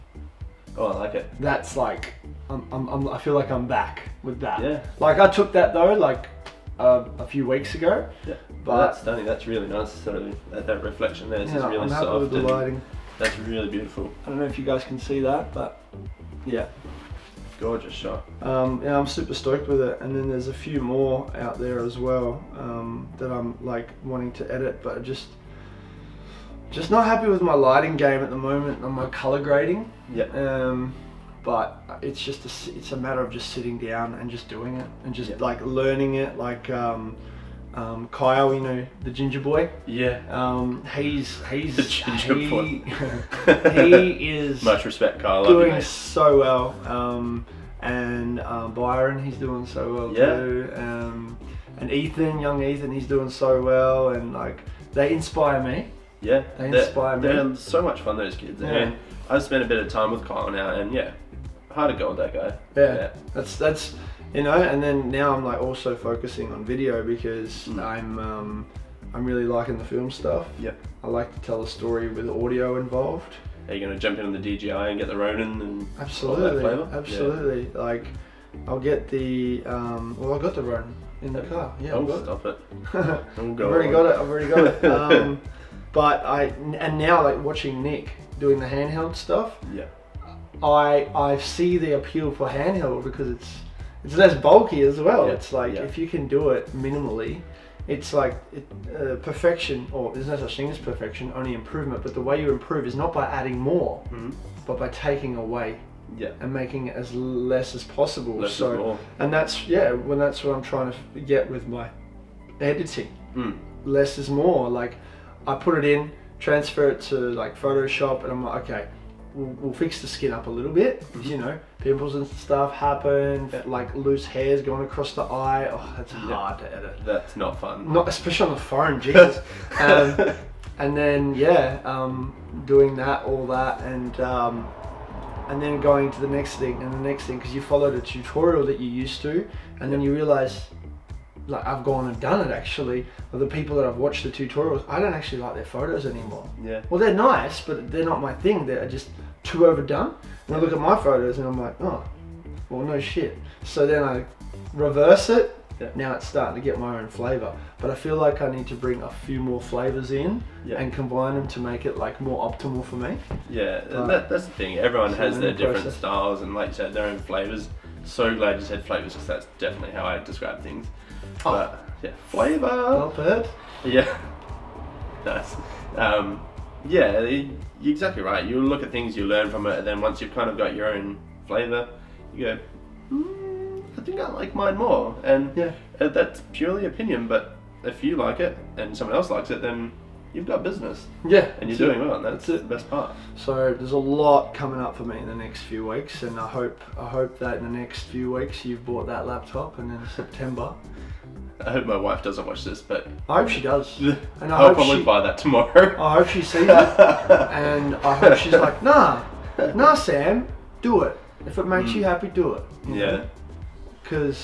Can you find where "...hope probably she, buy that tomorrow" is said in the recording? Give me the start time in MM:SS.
03:24.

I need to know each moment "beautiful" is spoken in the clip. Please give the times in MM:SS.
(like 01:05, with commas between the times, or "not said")
00:13.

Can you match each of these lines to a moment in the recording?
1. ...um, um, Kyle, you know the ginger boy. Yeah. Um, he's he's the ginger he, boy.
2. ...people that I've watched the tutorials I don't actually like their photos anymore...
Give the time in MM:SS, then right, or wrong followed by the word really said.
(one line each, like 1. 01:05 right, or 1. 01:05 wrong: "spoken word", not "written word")
1. 00:36 right
2. 02:23 right.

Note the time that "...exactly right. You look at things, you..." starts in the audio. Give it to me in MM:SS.
02:57.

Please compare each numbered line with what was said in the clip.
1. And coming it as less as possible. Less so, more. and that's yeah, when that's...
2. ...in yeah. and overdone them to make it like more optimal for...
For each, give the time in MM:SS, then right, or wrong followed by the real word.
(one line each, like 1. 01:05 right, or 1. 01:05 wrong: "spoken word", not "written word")
1. 01:46 wrong: "making", not "coming"
2. 02:40 wrong: "combine", not "overdone".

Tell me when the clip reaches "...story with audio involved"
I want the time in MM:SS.
01:11.